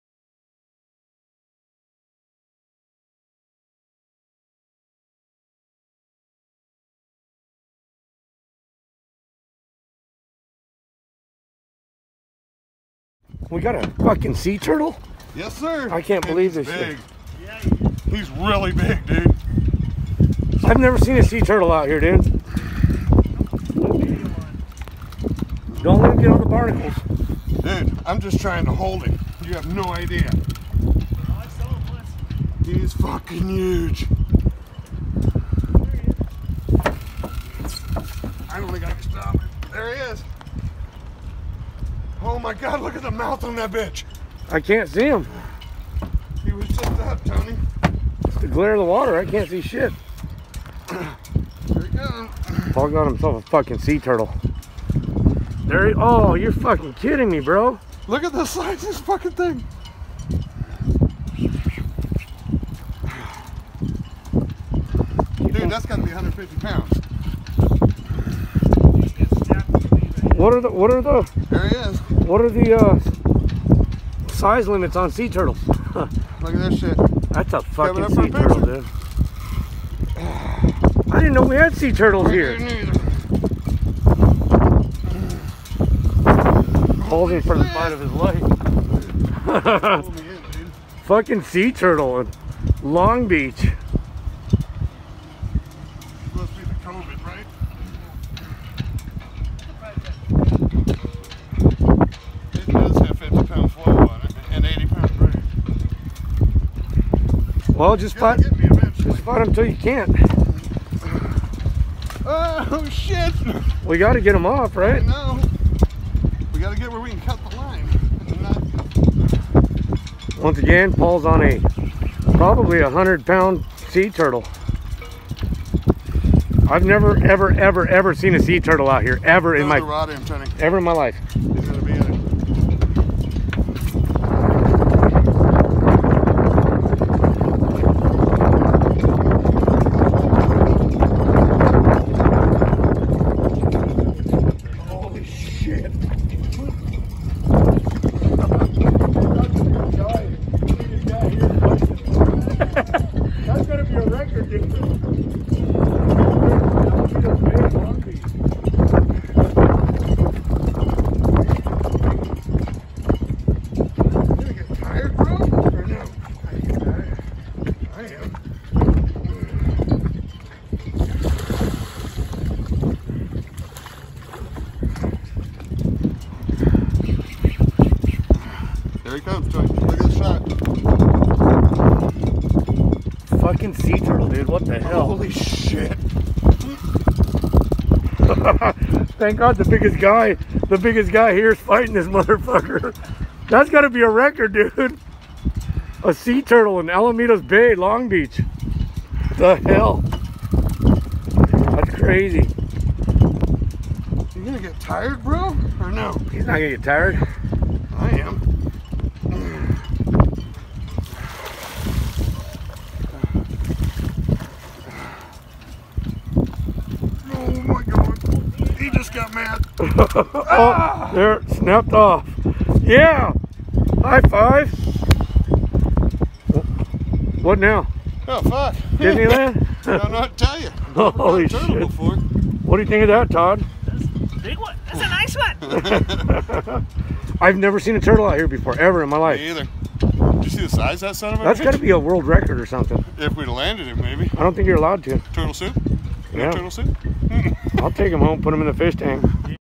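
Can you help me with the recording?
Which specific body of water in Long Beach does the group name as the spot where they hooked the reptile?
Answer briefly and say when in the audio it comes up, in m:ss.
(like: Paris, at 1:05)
Alamitos Bay, at 3:16.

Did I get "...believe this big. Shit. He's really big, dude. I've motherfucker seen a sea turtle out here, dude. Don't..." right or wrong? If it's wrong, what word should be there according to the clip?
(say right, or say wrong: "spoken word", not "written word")
wrong: "never", not "motherfucker".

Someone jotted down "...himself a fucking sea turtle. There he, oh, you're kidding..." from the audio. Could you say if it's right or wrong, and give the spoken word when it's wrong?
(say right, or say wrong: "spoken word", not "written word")
wrong: "fucking", not "kidding".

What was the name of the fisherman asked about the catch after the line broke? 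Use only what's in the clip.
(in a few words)
Todd.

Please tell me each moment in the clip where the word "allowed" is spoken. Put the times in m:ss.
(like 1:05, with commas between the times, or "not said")
4:04.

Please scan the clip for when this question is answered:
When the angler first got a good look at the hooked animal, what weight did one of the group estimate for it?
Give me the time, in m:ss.
1:06.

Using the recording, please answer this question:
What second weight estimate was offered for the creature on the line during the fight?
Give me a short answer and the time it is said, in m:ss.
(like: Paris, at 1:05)
100 pounds, at 2:02.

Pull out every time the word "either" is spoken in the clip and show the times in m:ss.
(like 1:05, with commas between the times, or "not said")
3:59.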